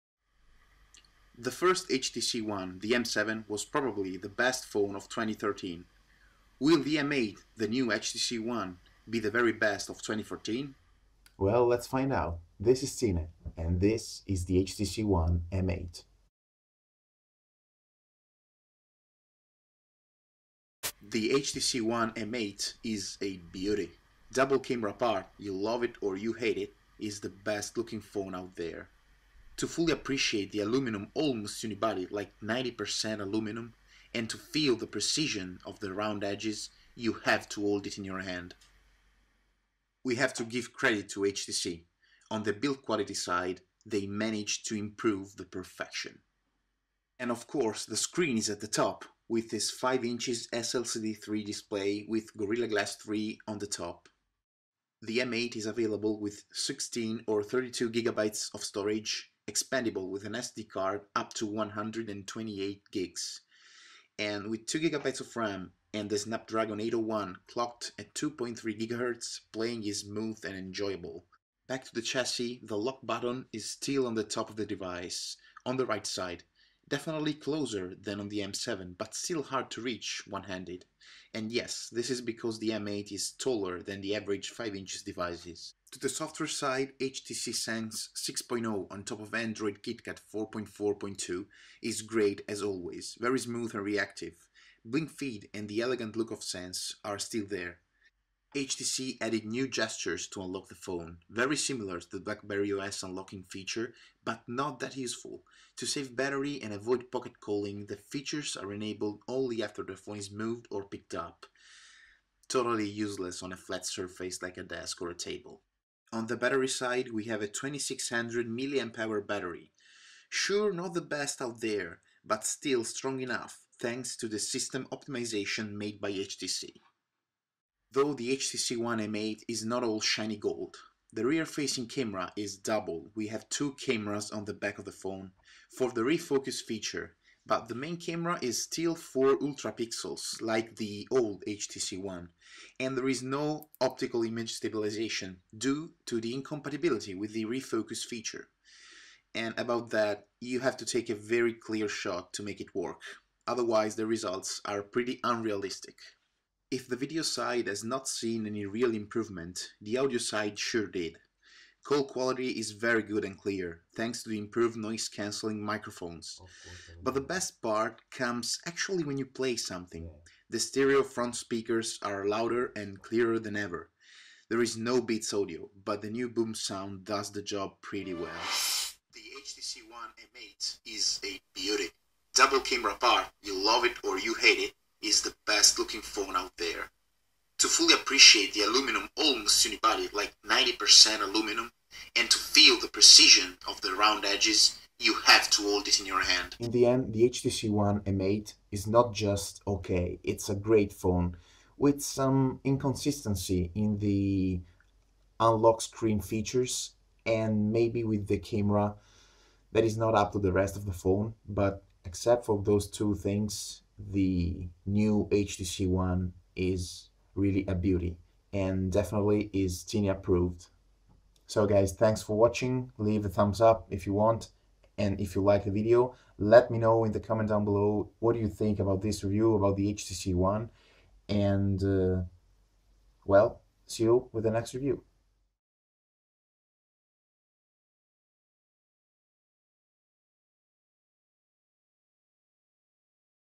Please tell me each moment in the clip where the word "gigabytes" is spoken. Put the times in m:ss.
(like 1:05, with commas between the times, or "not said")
0:57, 1:04.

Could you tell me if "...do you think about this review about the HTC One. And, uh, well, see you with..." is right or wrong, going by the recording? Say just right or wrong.
right.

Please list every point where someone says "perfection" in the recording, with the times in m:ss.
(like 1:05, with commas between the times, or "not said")
0:45.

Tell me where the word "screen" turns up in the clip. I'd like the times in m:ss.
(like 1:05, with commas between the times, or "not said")
0:47, 3:25.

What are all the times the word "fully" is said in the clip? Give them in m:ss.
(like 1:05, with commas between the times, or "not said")
0:29, 3:07.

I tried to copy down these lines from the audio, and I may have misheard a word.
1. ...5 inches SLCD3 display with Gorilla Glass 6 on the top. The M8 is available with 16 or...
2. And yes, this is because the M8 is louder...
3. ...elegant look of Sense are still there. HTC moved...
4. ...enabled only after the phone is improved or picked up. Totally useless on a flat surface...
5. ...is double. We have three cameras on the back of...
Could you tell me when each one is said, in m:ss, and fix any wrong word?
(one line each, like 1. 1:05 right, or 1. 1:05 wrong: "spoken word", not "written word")
1. 0:49 wrong: "3", not "6"
2. 1:21 wrong: "taller", not "louder"
3. 1:35 wrong: "added", not "moved"
4. 1:48 wrong: "moved", not "improved"
5. 2:12 wrong: "two", not "three".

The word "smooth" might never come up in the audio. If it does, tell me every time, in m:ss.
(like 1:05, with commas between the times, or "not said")
1:10, 1:33.